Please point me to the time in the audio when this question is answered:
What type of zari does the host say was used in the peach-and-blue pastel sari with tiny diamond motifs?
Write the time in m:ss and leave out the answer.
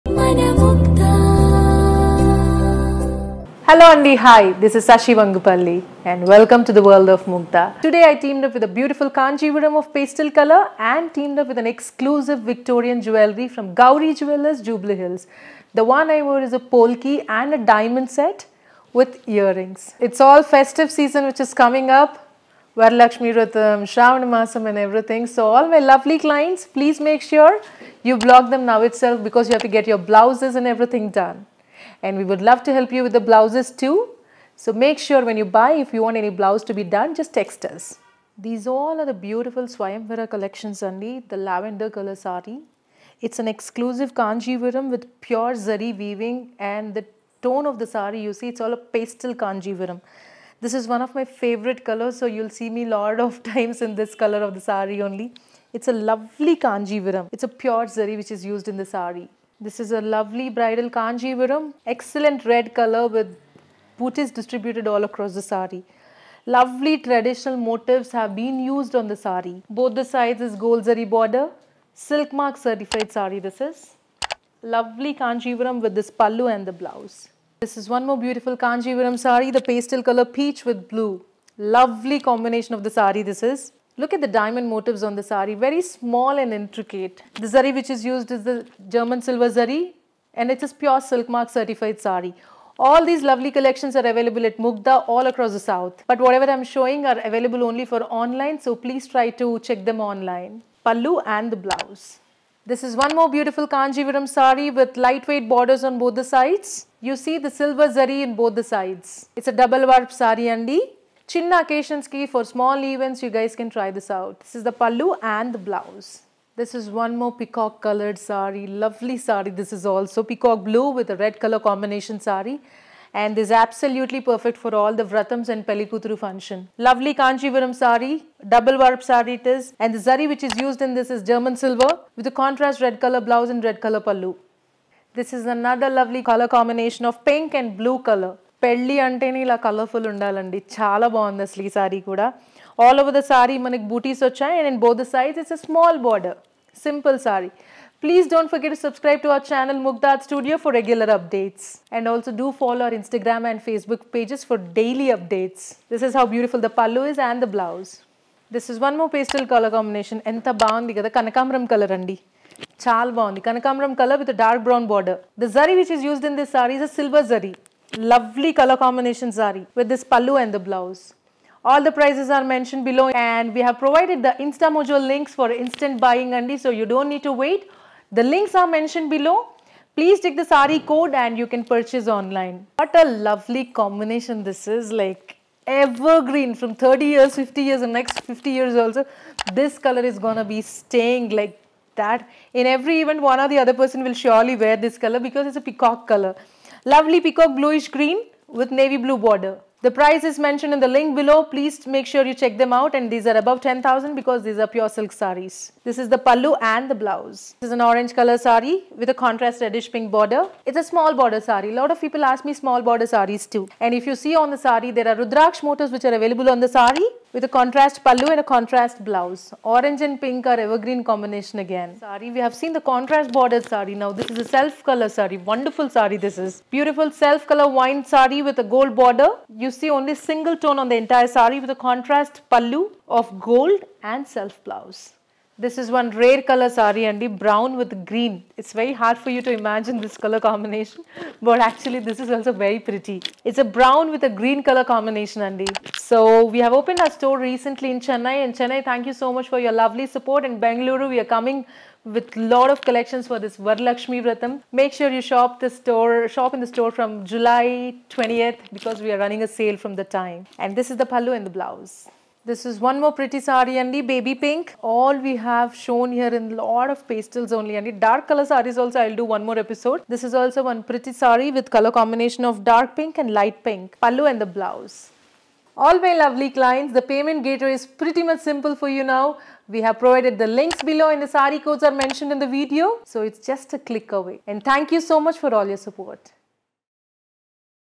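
1:28.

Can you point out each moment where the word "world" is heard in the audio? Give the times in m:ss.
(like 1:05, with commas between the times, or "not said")
0:06.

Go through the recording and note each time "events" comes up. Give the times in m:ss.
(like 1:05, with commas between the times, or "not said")
1:52, 3:13.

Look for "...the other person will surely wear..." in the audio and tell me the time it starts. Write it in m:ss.
3:13.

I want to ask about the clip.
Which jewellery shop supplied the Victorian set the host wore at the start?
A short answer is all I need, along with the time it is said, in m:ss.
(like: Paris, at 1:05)
Gauri Jewellers, at 0:13.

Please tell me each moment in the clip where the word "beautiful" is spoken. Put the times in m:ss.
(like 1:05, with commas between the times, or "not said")
0:08, 0:39, 1:18, 1:43, 2:36, 3:46.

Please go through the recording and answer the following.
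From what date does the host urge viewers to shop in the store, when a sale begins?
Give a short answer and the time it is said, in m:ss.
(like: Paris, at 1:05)
July 20th, at 4:17.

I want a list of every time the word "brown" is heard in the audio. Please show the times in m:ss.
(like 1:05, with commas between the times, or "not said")
2:44, 3:57, 4:03.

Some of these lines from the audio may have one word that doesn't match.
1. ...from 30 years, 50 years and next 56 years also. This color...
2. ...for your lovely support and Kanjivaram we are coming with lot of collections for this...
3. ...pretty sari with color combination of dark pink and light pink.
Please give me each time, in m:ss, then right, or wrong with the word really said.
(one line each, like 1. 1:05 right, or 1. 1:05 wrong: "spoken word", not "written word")
1. 3:06 wrong: "50", not "56"
2. 4:09 wrong: "Bengaluru", not "Kanjivaram"
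3. 4:30 right.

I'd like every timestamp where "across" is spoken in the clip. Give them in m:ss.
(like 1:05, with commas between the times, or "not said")
1:05, 1:35.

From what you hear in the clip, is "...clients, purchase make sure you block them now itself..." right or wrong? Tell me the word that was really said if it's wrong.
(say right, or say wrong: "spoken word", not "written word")
wrong: "please", not "purchase".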